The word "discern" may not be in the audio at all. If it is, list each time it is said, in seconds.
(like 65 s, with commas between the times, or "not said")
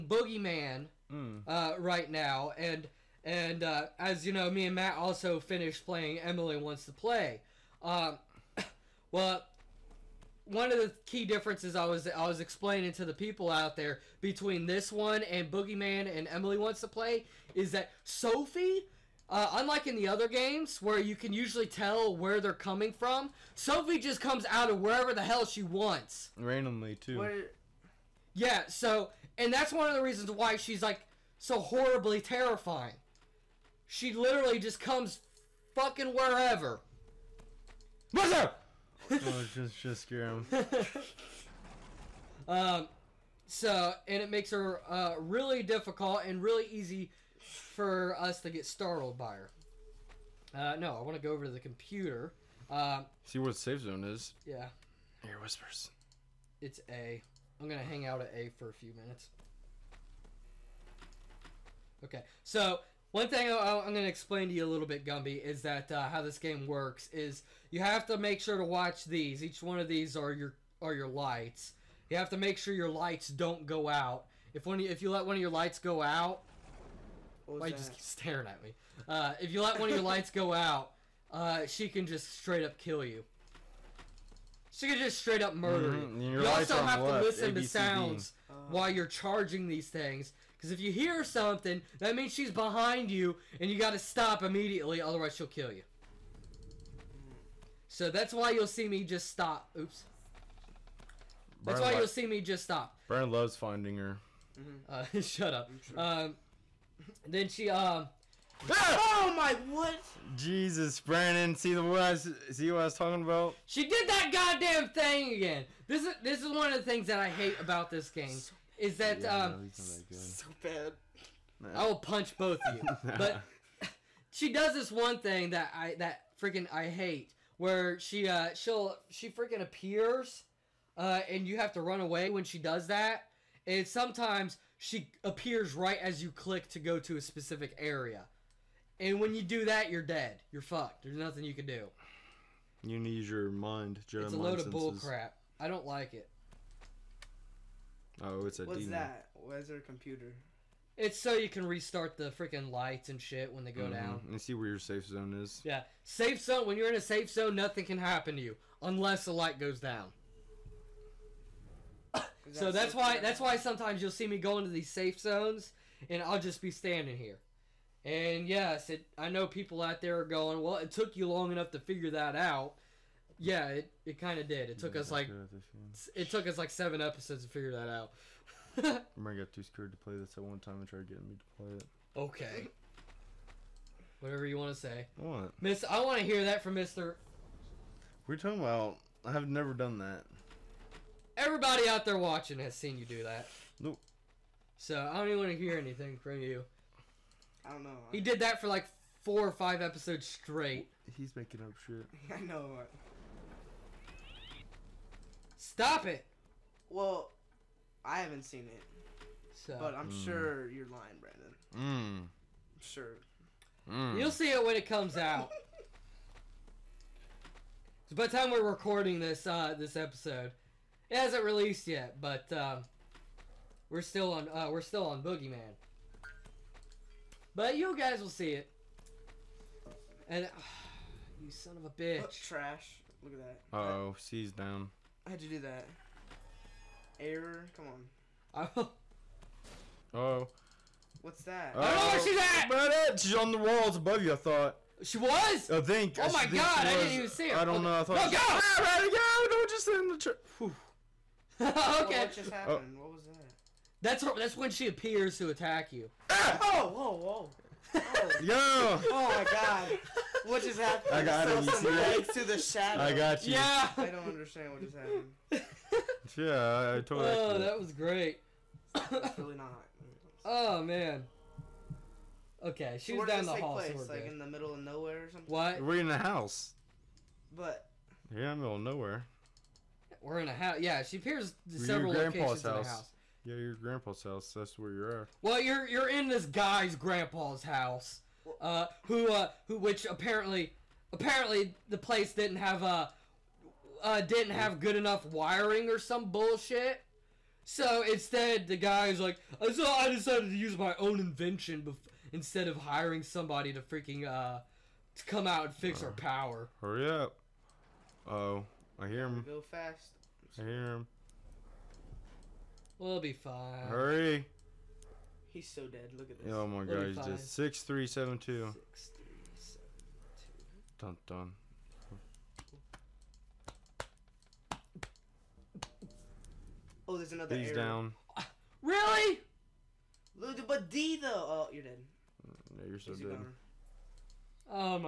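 not said.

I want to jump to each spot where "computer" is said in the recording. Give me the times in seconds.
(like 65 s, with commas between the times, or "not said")
51 s, 149 s.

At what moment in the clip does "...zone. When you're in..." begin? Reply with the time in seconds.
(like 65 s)
156 s.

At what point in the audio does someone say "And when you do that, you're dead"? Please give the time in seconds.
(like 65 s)
139 s.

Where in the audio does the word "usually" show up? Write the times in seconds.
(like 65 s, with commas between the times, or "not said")
21 s.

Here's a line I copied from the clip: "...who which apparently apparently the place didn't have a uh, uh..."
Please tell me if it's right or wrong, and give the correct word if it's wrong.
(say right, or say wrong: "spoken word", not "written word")
right.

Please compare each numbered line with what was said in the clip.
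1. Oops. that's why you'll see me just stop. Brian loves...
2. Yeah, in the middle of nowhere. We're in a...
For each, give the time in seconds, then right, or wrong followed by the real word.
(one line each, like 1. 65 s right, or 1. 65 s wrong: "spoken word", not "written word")
1. 99 s right
2. 278 s right.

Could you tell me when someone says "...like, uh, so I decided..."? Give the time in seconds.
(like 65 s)
299 s.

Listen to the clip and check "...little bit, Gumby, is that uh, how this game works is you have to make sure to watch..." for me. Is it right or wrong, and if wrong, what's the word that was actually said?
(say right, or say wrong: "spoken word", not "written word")
right.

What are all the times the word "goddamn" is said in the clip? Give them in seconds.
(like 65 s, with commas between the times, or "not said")
114 s.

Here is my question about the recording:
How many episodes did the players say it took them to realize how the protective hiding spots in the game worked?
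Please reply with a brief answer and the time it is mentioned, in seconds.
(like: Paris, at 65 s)
7, at 176 s.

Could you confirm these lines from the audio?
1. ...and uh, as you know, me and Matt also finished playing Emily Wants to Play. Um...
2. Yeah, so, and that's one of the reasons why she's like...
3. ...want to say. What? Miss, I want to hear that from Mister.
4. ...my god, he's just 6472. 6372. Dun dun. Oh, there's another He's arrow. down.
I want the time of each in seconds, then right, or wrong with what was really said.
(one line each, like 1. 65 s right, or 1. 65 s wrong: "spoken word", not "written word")
1. 3 s right
2. 28 s right
3. 184 s right
4. 316 s wrong: "6372", not "6472".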